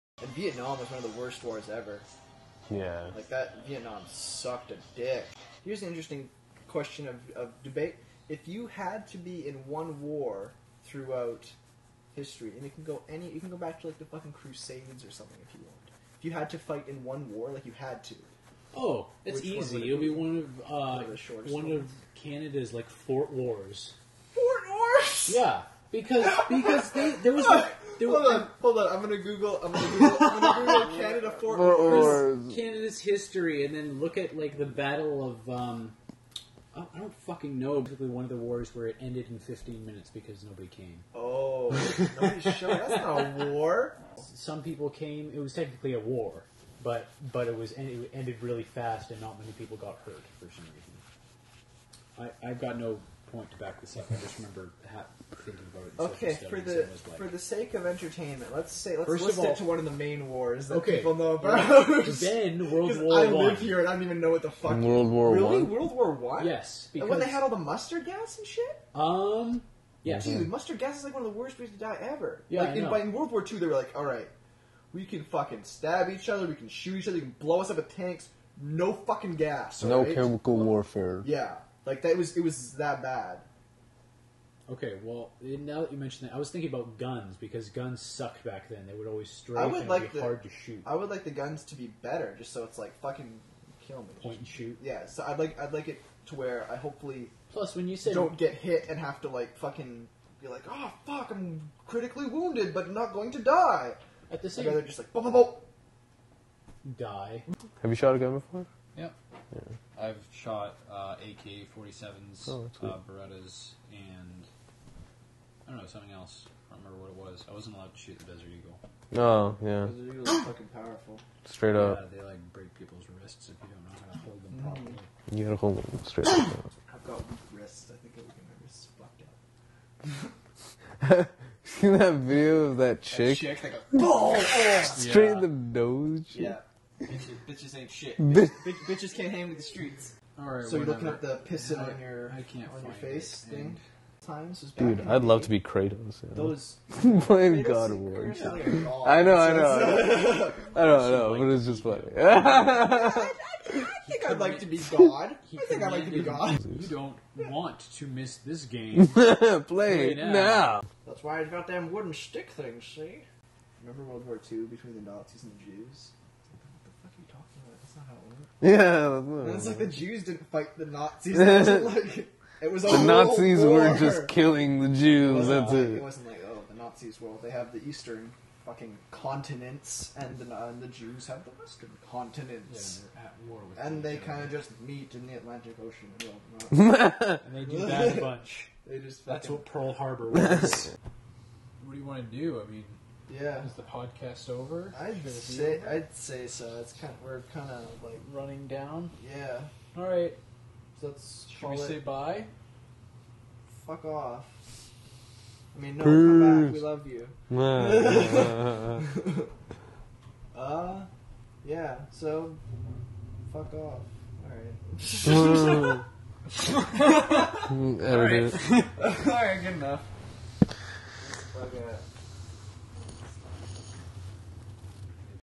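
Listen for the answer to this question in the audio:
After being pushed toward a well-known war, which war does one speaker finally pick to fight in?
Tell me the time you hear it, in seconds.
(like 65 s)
65 s.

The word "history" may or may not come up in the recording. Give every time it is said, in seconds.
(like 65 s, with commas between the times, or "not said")
12 s, 32 s.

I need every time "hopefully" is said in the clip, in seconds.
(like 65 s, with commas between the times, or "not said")
96 s.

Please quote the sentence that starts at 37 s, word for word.
Basically, one of the wars where it ended in 15 minutes because nobody came.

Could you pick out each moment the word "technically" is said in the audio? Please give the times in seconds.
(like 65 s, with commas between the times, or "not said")
45 s.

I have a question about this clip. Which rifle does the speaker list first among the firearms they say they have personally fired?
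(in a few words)
AK-47s.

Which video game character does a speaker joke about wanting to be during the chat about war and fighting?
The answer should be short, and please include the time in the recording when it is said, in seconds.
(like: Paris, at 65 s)
Kratos, at 145 s.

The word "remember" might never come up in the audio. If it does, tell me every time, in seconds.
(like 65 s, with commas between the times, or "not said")
54 s, 116 s, 163 s.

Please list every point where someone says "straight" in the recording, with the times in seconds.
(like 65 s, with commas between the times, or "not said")
121 s, 126 s, 134 s.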